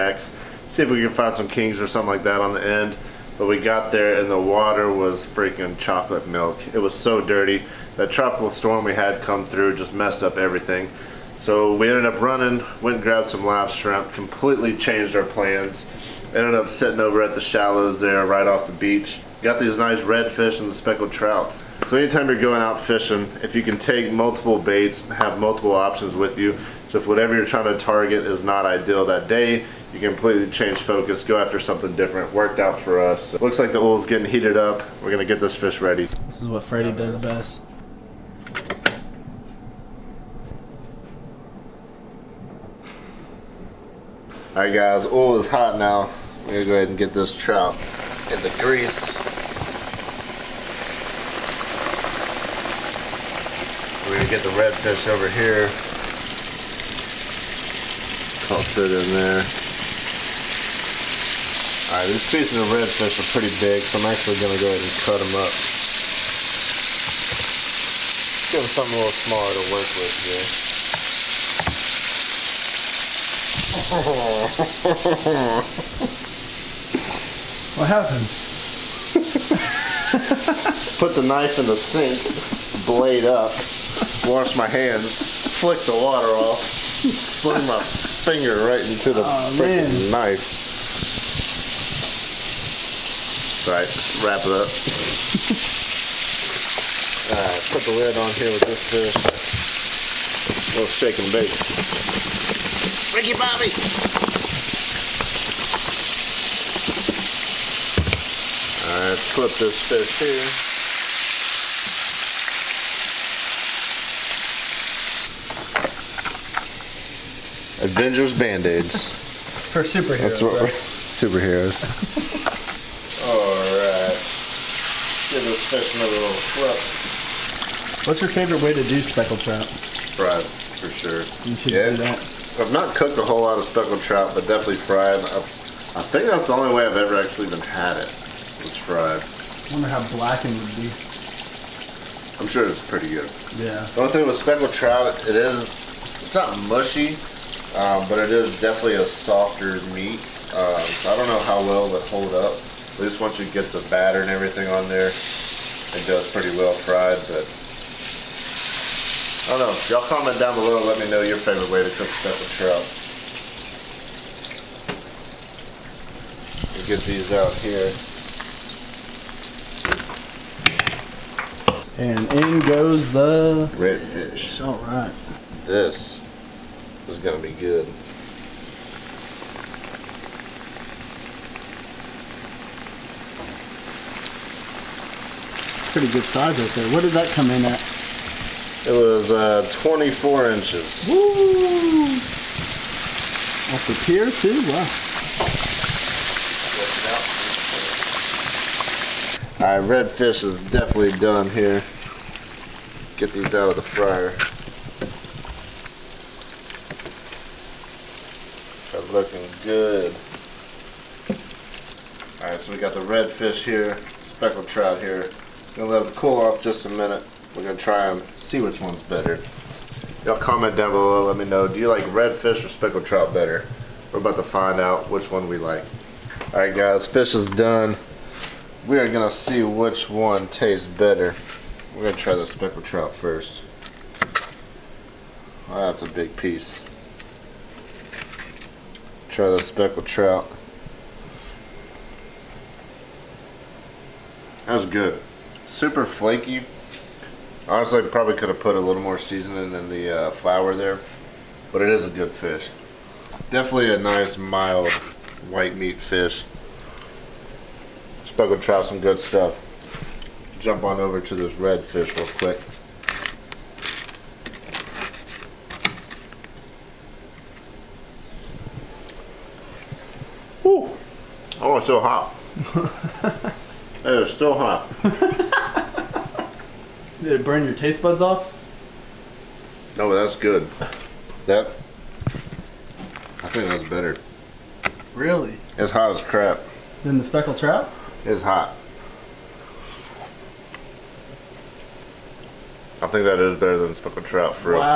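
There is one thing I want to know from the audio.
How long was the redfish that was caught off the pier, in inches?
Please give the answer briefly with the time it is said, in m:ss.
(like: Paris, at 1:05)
24, at 3:09.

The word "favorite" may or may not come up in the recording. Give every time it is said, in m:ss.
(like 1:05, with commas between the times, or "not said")
2:08, 2:41.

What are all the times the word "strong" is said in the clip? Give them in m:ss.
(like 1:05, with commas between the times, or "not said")
not said.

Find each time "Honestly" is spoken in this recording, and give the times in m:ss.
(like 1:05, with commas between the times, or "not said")
4:07.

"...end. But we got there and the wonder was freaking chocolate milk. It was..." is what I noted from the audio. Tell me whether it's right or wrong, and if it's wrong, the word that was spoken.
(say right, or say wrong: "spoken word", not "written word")
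wrong: "water", not "wonder".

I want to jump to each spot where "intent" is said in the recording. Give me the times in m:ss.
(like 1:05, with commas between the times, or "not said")
not said.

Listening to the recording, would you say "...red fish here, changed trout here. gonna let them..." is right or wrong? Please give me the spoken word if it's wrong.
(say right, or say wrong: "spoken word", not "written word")
wrong: "speckled", not "changed".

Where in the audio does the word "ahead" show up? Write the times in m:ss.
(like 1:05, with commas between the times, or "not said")
0:46, 1:04.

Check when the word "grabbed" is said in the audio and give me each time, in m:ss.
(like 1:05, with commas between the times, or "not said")
0:13.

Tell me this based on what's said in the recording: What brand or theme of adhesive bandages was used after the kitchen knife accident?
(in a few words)
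Avengers.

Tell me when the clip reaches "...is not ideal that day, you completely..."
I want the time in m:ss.
0:28.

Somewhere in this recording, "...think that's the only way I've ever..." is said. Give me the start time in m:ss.
2:16.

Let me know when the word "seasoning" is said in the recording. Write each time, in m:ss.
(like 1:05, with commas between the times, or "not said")
4:09.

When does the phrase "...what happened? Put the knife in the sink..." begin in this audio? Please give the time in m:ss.
1:17.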